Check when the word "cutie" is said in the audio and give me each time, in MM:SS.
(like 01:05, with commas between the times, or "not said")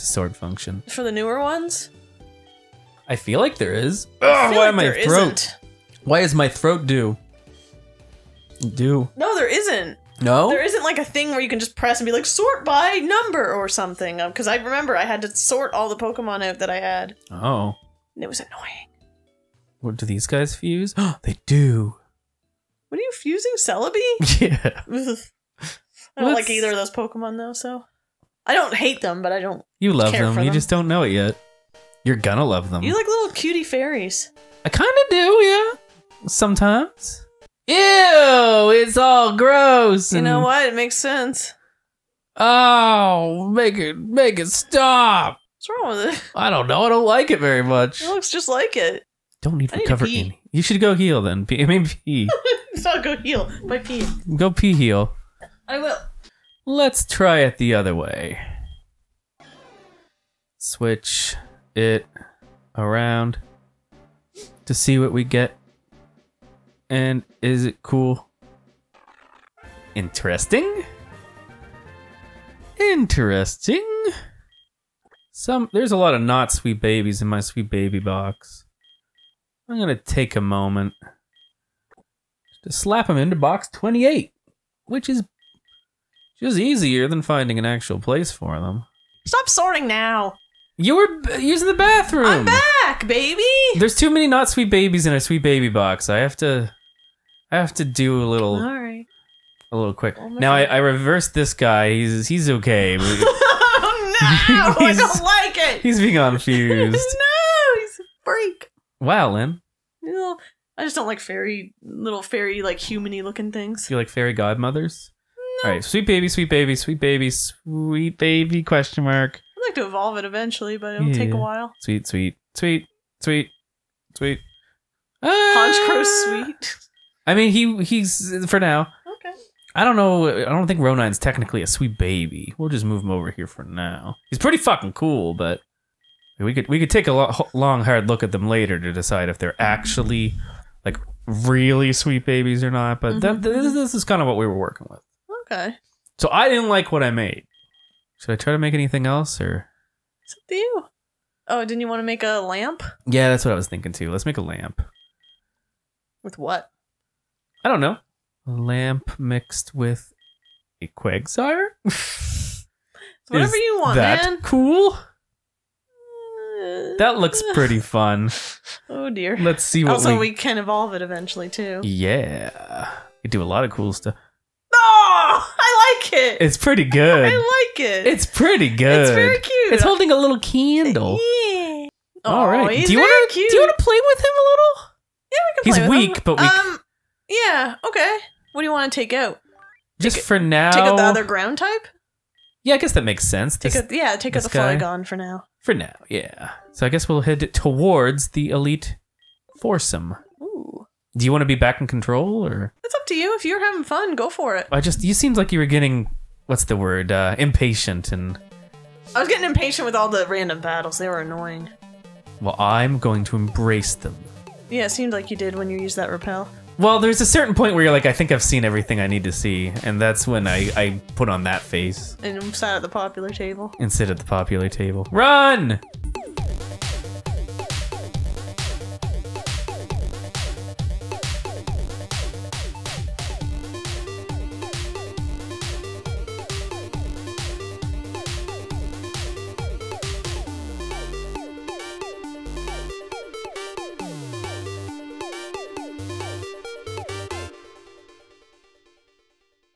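00:33.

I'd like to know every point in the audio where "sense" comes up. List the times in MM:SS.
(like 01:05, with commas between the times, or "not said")
00:40, 03:13.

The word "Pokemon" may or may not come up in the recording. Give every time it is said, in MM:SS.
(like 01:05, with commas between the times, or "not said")
00:15, 00:26.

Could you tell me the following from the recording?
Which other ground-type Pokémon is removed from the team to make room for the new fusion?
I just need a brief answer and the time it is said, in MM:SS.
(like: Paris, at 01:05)
Flygon, at 03:14.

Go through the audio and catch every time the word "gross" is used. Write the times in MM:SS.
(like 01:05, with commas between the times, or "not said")
00:39.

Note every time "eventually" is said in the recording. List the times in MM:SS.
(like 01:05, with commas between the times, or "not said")
02:00, 02:51.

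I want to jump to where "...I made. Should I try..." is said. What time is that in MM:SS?
02:27.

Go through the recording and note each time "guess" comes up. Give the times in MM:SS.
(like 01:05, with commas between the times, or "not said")
03:12, 03:16.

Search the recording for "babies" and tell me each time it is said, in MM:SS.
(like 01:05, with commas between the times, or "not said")
01:16, 01:34, 02:22.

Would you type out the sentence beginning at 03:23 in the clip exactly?
If you're having fun, go for it.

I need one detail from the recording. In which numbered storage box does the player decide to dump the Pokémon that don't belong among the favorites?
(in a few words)
28.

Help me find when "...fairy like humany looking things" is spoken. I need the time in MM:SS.
01:52.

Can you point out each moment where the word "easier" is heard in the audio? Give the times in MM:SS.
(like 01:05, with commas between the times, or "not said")
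01:26.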